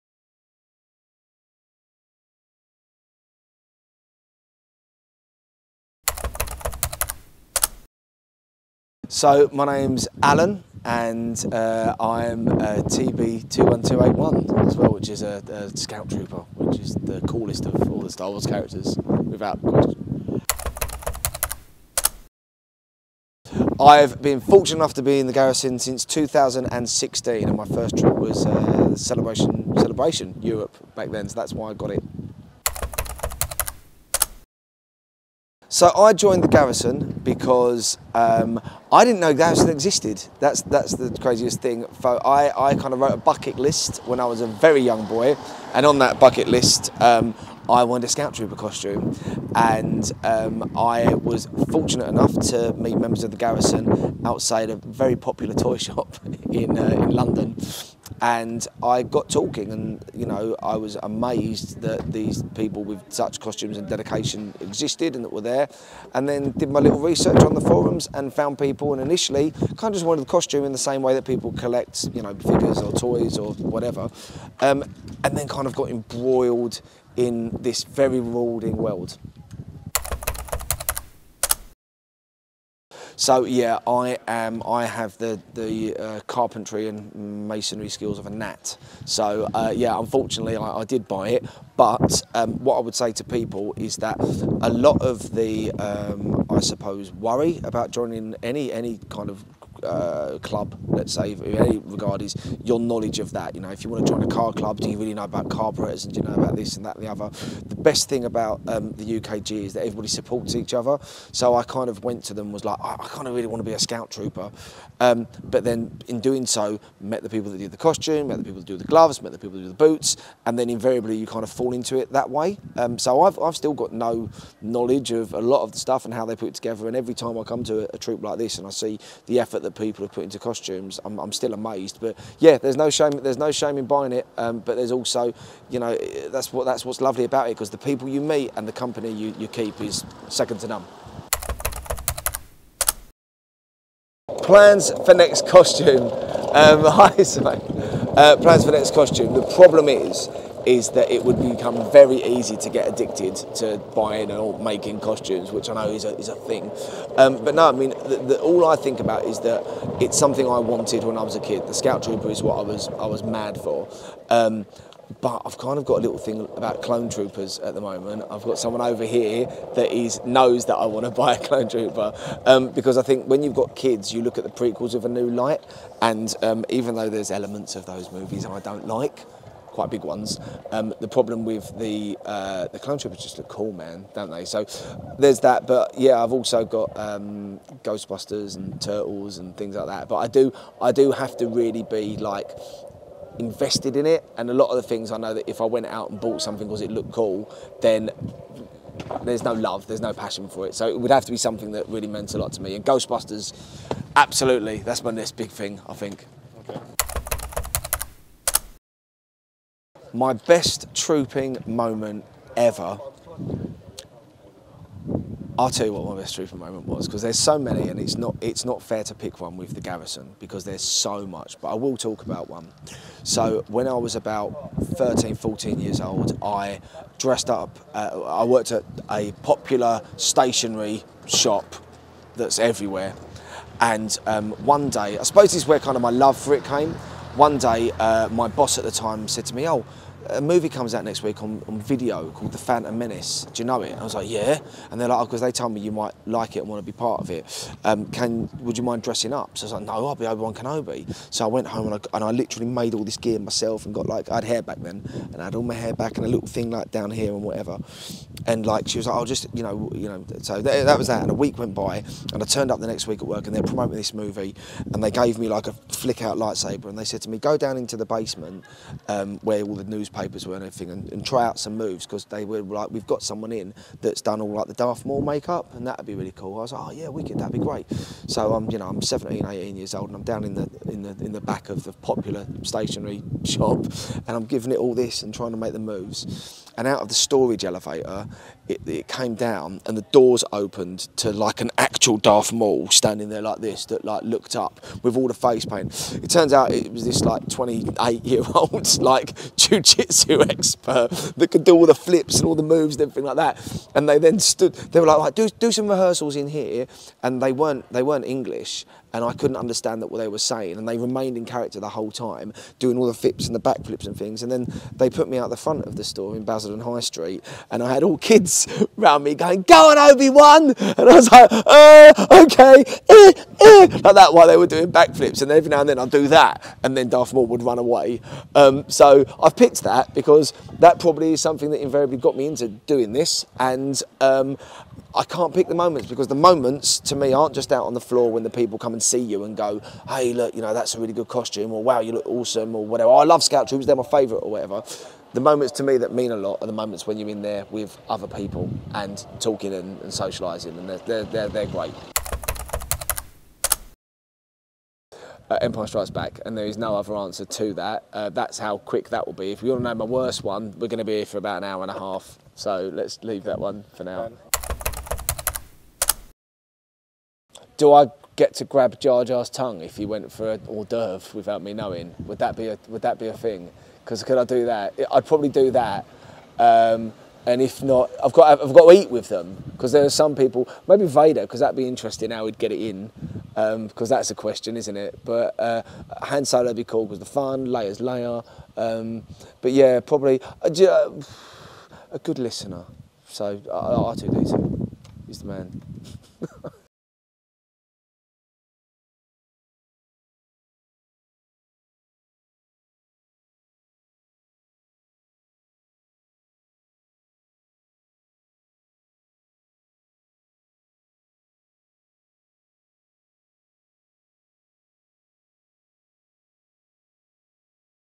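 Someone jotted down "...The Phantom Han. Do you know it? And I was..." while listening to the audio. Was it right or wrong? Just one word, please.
wrong.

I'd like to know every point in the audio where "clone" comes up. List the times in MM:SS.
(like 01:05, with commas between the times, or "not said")
02:46, 02:51, 03:02.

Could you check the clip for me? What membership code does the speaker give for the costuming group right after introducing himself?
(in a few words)
TB21281.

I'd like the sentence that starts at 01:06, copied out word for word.
And then did my little research on the forums and found people.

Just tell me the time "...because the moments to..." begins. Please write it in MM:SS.
05:36.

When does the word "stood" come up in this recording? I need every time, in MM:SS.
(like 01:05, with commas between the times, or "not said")
05:04.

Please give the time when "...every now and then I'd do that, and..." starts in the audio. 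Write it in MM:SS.
05:25.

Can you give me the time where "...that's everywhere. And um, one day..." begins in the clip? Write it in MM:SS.
03:52.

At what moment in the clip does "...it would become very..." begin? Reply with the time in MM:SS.
02:31.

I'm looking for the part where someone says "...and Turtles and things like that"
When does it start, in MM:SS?
03:08.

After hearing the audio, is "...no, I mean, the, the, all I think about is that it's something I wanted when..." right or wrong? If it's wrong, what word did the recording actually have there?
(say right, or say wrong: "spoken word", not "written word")
right.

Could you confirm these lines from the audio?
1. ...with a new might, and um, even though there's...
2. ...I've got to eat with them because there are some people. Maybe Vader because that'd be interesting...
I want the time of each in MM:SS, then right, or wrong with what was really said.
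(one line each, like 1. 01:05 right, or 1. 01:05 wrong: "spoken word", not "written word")
1. 02:54 wrong: "light", not "might"
2. 06:18 right.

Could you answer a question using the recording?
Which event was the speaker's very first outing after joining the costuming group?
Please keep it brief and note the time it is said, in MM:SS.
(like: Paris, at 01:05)
Celebration Europe, at 00:29.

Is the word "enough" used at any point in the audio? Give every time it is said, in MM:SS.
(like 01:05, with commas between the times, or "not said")
00:24, 00:52.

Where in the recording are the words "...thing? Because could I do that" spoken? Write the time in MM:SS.
06:13.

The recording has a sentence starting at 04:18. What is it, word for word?
And like she was like, I'll oh, just you know you know.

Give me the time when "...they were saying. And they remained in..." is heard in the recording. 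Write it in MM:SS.
05:10.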